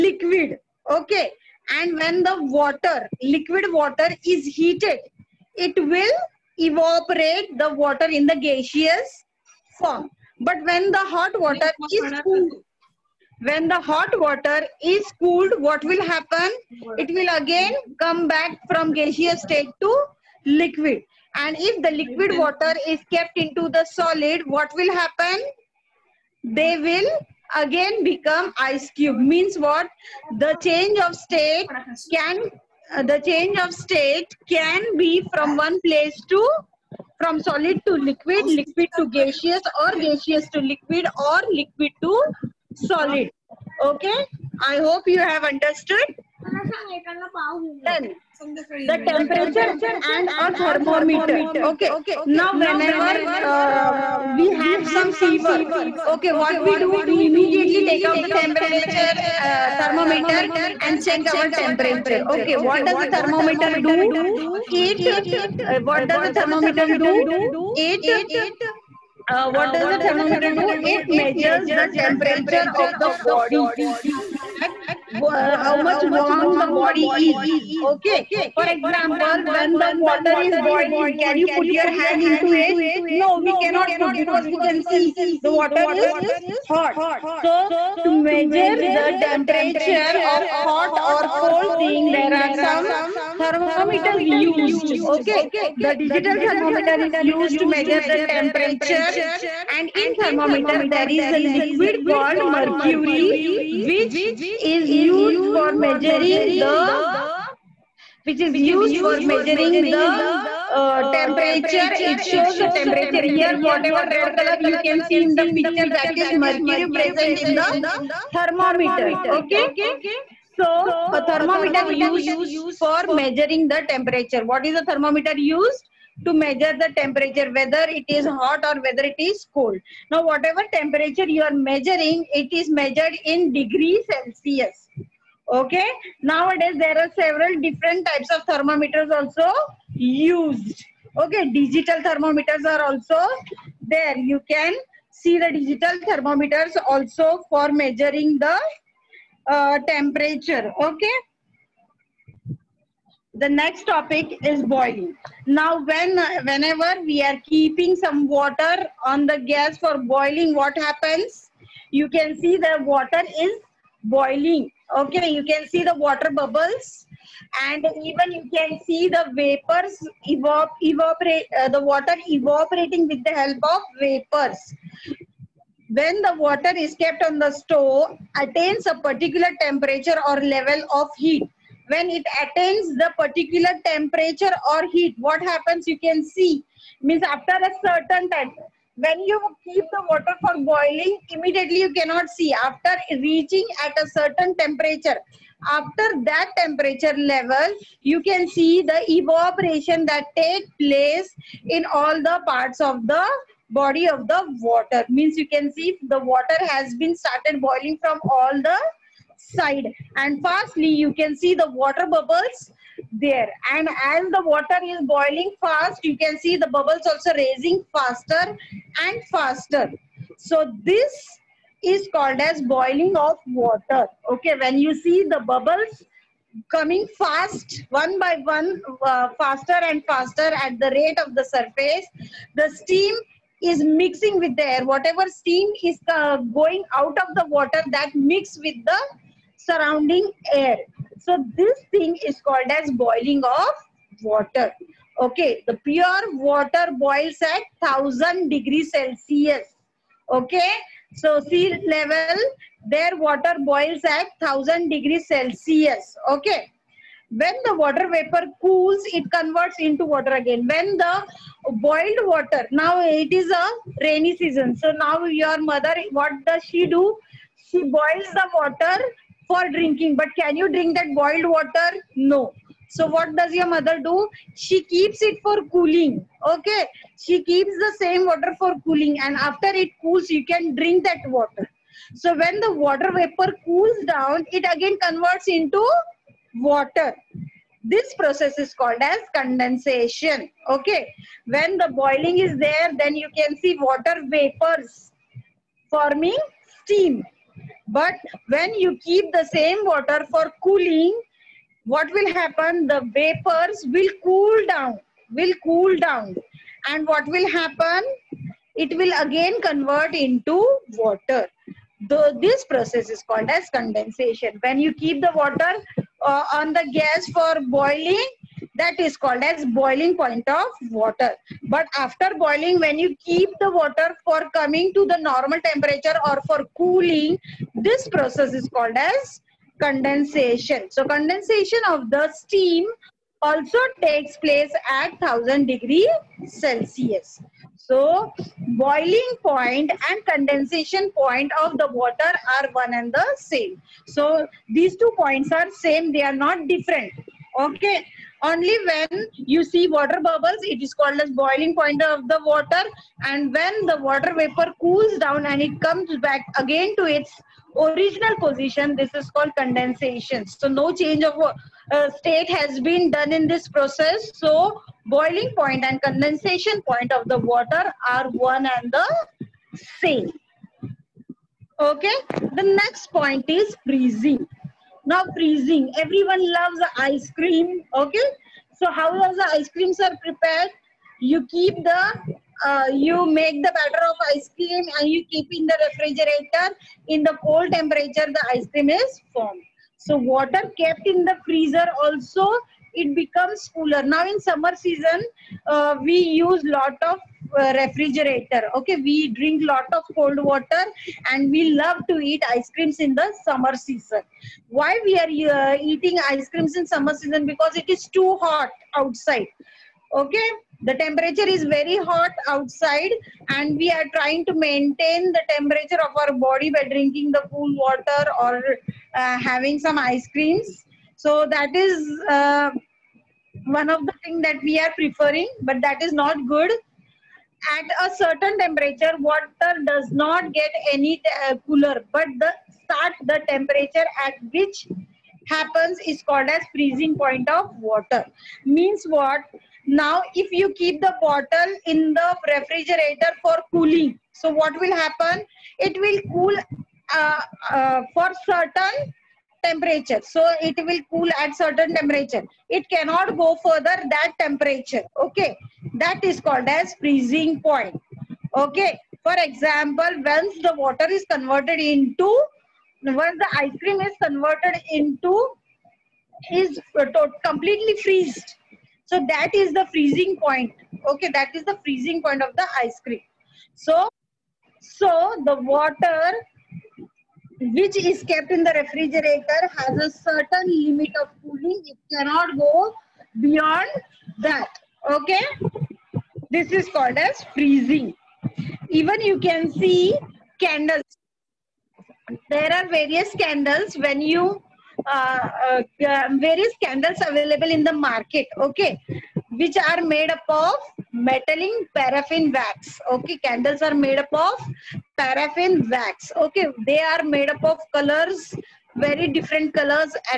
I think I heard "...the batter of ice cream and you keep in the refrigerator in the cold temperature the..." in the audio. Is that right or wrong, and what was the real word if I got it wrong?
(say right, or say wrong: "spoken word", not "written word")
right.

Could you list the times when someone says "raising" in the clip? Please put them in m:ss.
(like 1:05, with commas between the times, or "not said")
3:37.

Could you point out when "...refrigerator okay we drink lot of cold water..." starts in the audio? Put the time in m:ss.
6:37.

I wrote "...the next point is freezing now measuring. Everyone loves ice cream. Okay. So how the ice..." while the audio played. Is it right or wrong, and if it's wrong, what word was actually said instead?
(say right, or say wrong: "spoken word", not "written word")
wrong: "freezing", not "measuring".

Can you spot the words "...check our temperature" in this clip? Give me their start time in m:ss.
1:01.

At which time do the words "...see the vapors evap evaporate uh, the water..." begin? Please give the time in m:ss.
2:48.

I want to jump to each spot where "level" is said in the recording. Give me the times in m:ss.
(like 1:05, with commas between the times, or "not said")
3:00, 3:17, 4:11.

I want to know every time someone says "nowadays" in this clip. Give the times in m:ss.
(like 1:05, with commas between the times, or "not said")
2:16.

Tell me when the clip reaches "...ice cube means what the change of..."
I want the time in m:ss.
0:28.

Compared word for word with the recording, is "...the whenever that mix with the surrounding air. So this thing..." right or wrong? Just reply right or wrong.
wrong.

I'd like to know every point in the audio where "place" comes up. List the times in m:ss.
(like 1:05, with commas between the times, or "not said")
0:35, 3:20, 5:34.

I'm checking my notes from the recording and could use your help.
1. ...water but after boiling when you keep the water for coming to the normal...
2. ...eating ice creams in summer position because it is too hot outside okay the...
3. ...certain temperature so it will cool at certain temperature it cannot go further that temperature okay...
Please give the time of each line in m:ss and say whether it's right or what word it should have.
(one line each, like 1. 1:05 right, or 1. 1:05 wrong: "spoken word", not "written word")
1. 5:20 right
2. 6:45 wrong: "season", not "position"
3. 7:28 right.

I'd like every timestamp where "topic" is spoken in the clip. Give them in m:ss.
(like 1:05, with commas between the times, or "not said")
2:33.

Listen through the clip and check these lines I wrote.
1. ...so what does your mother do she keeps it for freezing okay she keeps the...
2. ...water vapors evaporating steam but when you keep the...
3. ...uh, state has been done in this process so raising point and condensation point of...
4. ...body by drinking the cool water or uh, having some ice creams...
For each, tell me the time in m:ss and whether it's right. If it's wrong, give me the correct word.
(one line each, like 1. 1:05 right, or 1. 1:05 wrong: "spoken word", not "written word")
1. 4:32 wrong: "cooling", not "freezing"
2. 4:53 wrong: "forming", not "evaporating"
3. 6:01 wrong: "boiling", not "raising"
4. 6:56 right.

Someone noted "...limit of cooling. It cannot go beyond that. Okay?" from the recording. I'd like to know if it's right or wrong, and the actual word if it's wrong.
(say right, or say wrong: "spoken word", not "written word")
right.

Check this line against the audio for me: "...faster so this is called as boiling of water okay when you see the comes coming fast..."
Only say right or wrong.
wrong.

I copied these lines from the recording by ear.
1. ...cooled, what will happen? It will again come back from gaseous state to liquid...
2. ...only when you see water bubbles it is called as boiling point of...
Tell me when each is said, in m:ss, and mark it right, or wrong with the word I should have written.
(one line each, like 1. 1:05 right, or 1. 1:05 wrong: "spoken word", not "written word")
1. 0:15 right
2. 5:48 right.